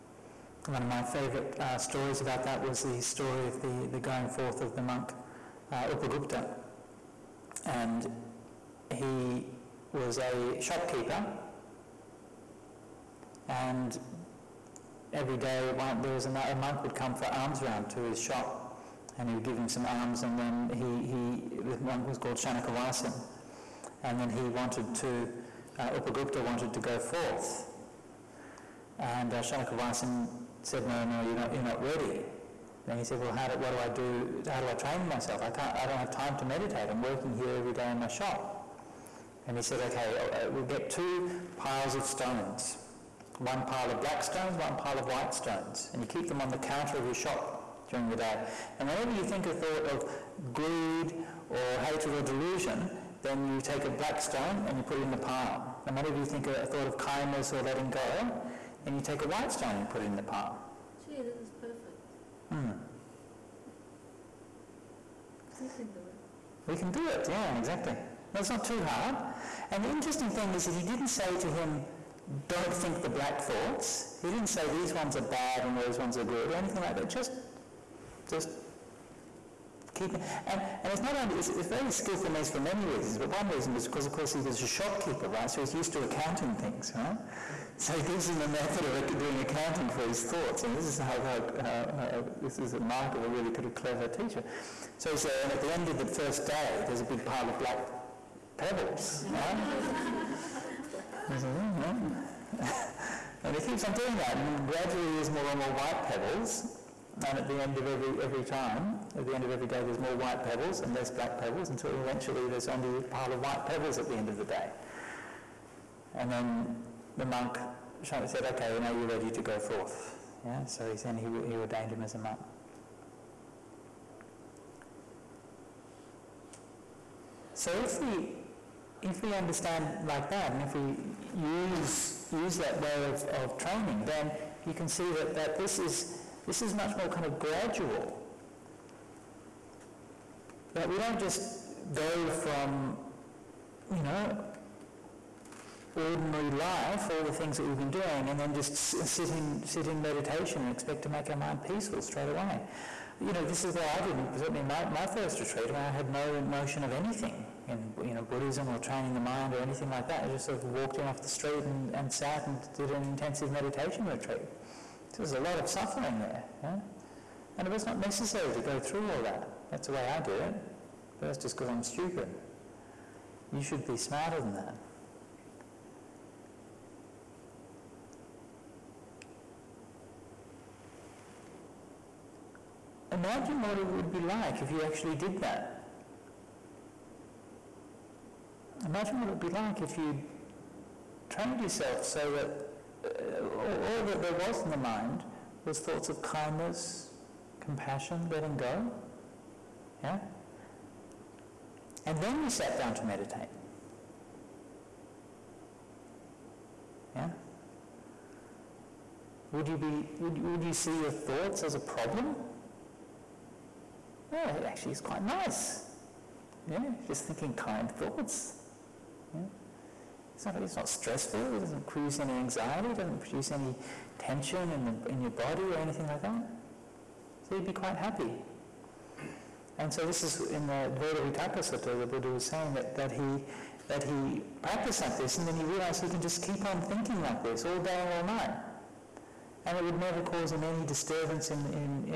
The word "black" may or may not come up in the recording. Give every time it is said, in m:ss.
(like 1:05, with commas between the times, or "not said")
0:44, 0:53, 1:13, 1:37, 1:51.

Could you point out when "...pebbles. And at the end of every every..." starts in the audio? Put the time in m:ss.
1:46.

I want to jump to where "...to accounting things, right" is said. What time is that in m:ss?
1:25.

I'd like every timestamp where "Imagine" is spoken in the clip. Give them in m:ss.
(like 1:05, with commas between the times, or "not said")
3:03, 3:08.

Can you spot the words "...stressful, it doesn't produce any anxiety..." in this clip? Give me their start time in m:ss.
3:40.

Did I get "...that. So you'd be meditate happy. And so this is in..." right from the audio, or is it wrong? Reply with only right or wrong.
wrong.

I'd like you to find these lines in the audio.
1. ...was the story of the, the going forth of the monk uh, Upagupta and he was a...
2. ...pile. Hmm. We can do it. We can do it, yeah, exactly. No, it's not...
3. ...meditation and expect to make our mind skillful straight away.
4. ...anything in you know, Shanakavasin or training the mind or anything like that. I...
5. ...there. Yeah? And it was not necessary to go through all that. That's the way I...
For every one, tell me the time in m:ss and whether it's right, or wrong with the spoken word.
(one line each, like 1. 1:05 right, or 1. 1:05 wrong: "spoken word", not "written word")
1. 0:02 right
2. 1:00 right
3. 2:30 wrong: "peaceful", not "skillful"
4. 2:36 wrong: "Buddhism", not "Shanakavasin"
5. 2:46 right.